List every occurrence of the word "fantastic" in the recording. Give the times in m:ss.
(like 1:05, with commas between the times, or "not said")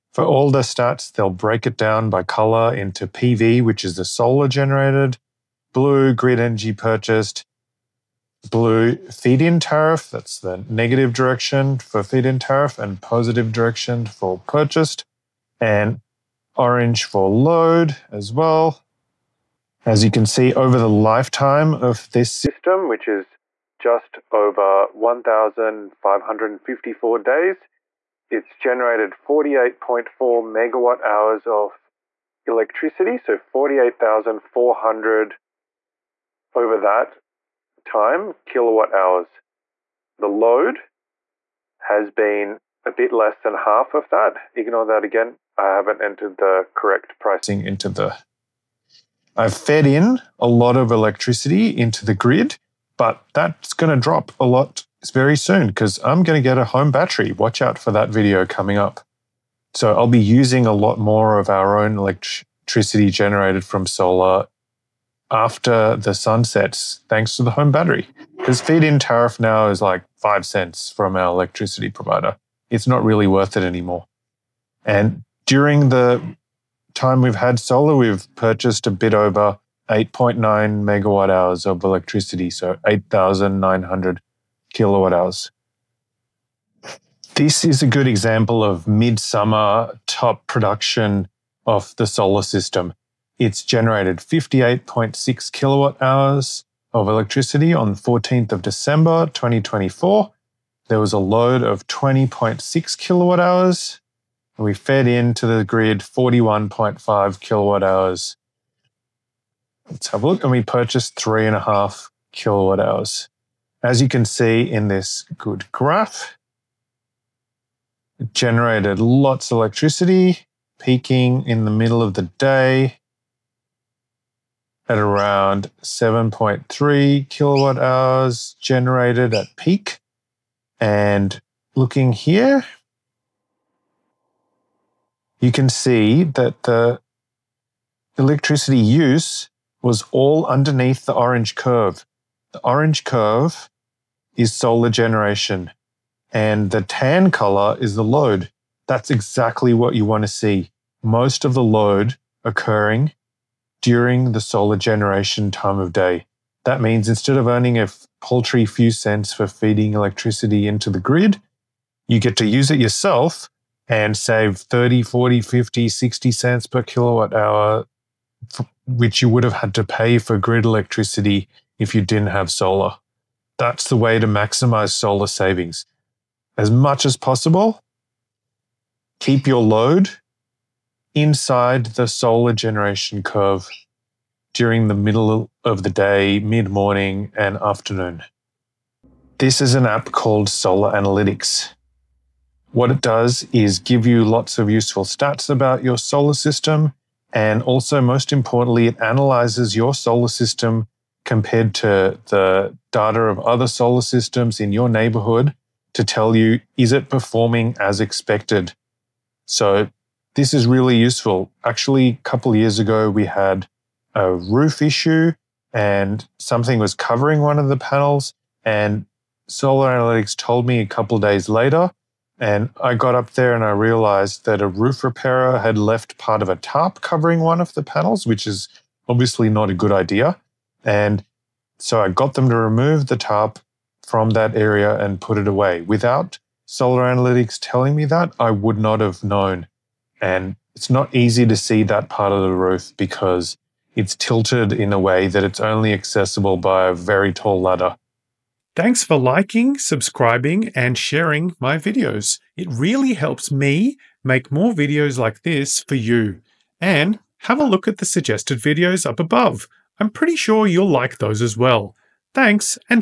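not said.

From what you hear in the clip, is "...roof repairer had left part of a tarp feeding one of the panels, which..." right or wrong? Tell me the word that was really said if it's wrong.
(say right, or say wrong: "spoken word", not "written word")
wrong: "covering", not "feeding".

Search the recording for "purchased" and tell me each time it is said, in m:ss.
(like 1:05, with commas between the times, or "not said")
0:06, 0:14, 1:18, 1:50.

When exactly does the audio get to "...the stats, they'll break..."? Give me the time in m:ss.
0:00.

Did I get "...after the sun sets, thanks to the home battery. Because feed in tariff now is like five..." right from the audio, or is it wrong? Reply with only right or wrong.
right.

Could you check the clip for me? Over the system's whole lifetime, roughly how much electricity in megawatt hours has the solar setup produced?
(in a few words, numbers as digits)
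48.4 megawatt hours.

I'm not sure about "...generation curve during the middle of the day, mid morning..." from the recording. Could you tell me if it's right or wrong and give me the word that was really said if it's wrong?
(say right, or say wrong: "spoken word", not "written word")
right.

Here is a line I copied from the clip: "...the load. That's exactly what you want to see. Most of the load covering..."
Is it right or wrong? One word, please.
wrong.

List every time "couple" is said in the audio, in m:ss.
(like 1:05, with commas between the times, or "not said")
3:32, 3:40.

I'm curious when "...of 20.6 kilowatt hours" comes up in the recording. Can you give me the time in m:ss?
1:41.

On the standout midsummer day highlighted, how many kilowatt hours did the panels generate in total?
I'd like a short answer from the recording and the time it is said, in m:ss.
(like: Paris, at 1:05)
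58.6 kilowatt hours, at 1:34.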